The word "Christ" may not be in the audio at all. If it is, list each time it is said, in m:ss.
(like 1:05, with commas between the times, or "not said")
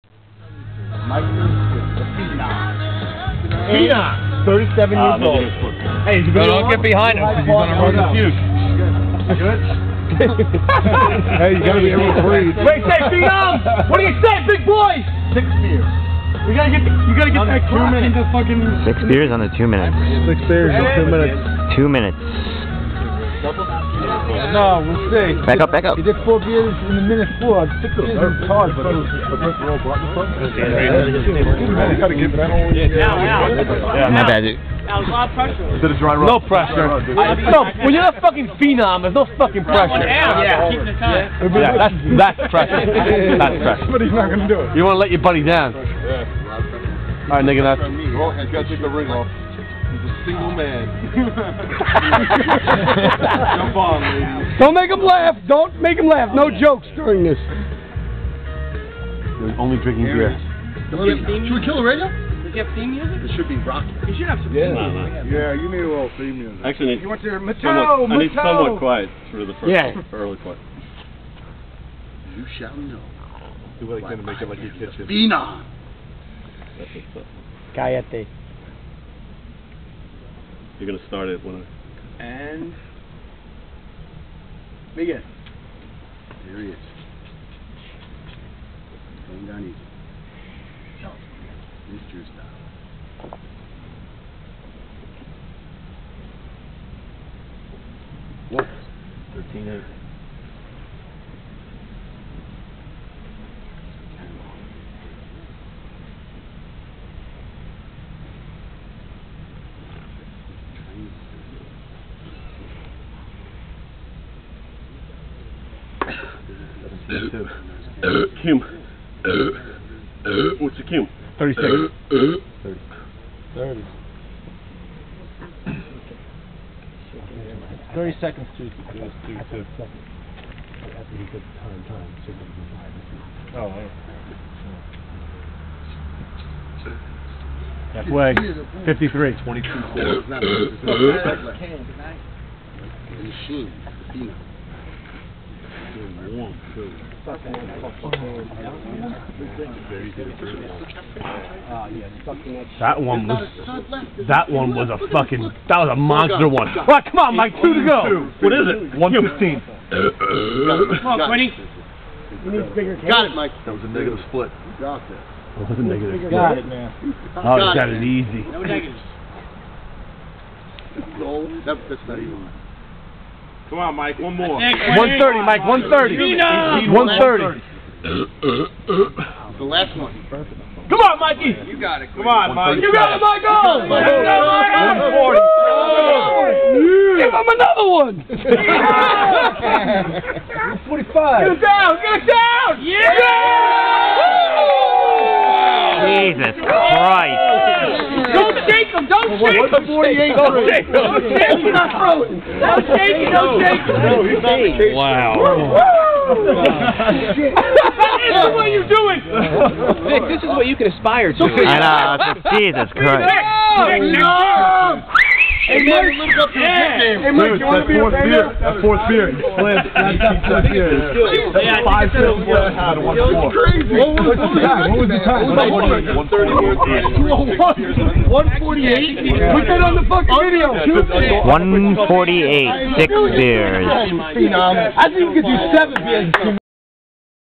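3:16, 3:32.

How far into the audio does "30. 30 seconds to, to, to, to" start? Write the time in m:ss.
2:03.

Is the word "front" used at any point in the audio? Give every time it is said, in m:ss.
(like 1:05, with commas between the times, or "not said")
0:30.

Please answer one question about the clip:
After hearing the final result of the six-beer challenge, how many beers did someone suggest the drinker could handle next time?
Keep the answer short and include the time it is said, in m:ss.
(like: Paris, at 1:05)
7, at 3:53.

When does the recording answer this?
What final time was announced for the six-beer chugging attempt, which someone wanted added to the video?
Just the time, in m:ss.
3:48.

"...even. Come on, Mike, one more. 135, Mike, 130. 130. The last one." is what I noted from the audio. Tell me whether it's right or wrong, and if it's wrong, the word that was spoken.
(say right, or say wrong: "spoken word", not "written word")
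wrong: "130", not "135".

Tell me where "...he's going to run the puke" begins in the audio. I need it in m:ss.
0:07.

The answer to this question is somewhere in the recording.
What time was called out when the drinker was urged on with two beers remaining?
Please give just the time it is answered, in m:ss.
2:38.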